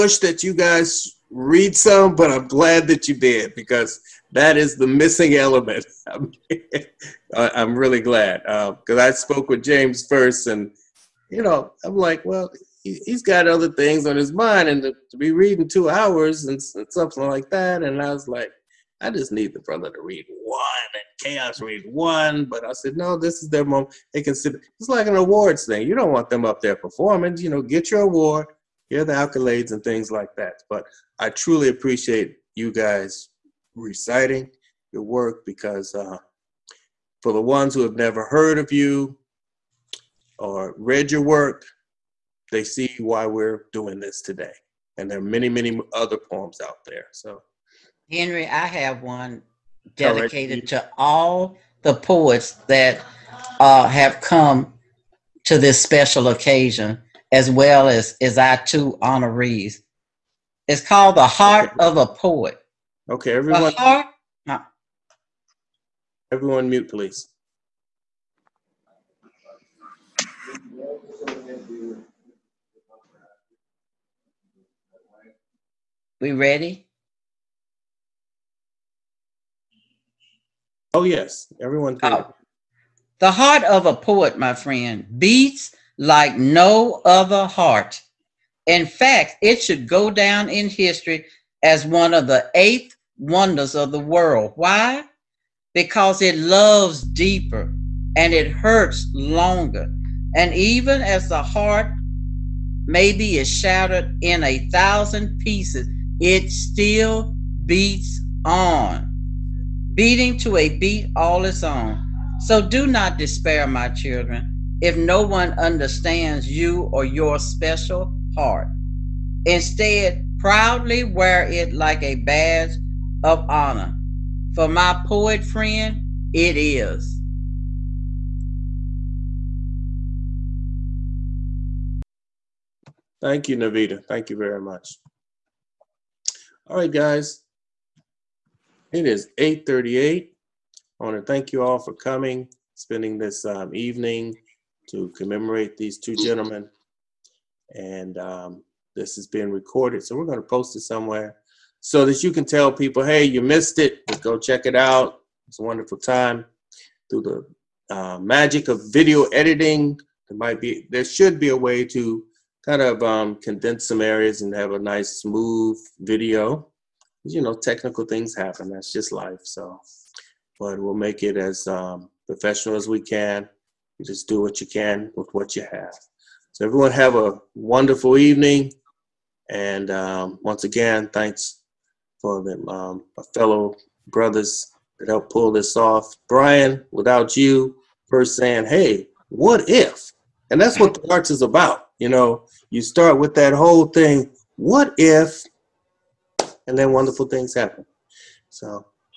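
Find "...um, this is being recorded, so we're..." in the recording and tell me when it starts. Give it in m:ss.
2:28.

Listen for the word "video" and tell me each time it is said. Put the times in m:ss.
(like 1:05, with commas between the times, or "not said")
2:38, 2:45.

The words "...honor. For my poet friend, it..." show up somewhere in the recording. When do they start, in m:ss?
2:03.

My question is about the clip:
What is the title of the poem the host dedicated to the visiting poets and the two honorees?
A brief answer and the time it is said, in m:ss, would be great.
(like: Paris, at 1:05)
The Heart of a Poet, at 1:01.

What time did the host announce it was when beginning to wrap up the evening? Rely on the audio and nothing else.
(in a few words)
8:38.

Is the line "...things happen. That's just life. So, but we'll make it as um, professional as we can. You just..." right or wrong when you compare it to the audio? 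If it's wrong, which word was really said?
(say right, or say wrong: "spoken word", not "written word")
right.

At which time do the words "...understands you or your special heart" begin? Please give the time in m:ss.
1:55.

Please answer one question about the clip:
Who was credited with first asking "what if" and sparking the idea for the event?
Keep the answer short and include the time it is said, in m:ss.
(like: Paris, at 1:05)
Brian, at 3:06.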